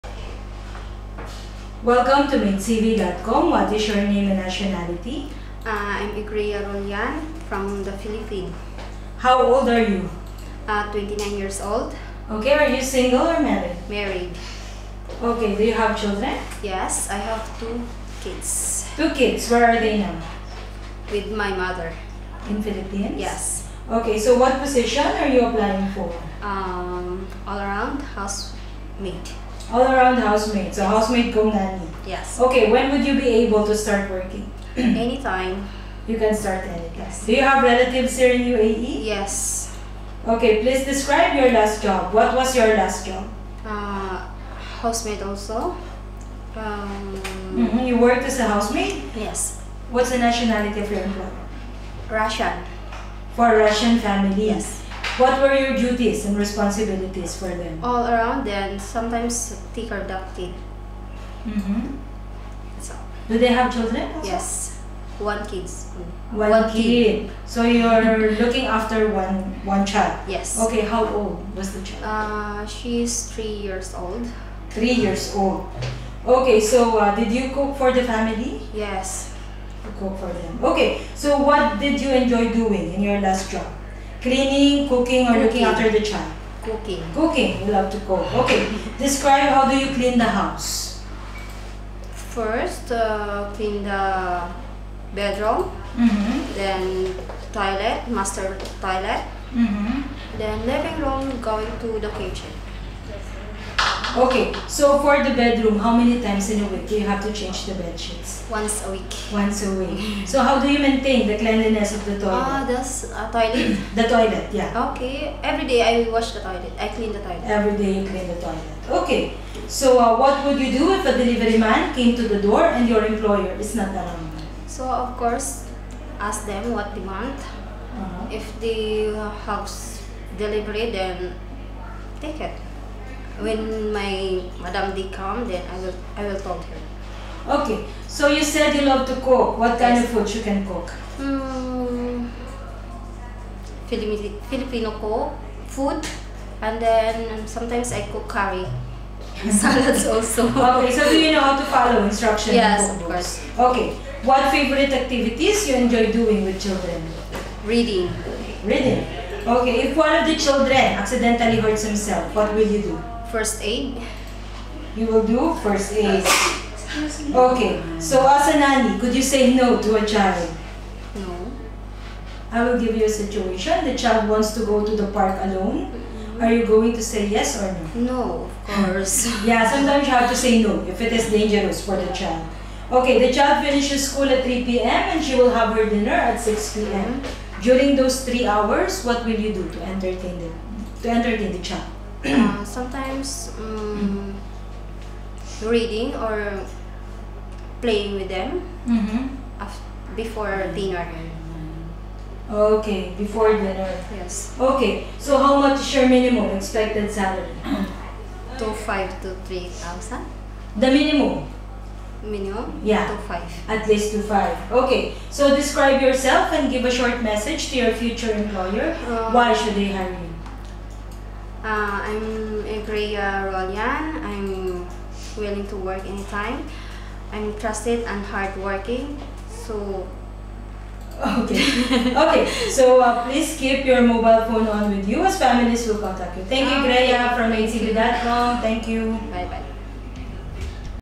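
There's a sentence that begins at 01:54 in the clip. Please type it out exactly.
Okay, every day I wash the toilet.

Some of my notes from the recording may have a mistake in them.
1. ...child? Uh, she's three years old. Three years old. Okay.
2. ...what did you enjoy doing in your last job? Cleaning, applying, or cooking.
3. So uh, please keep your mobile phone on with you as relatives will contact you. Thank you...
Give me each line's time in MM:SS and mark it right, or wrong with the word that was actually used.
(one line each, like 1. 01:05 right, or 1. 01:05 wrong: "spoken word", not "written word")
1. 01:11 right
2. 01:21 wrong: "cooking", not "applying"
3. 03:52 wrong: "families", not "relatives".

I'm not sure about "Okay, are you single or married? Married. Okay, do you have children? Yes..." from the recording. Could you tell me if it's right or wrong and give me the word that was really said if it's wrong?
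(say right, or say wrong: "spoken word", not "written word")
right.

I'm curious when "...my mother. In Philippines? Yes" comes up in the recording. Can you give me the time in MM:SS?
00:21.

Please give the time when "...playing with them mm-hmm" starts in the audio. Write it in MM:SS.
03:17.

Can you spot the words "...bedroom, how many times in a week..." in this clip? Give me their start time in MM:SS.
01:45.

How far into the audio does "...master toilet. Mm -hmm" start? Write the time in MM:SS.
01:38.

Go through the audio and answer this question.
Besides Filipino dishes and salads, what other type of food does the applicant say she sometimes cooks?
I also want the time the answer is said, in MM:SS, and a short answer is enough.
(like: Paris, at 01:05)
Curry, at 02:28.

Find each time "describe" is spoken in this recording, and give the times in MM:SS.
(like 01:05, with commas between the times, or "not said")
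00:40, 01:28, 03:35.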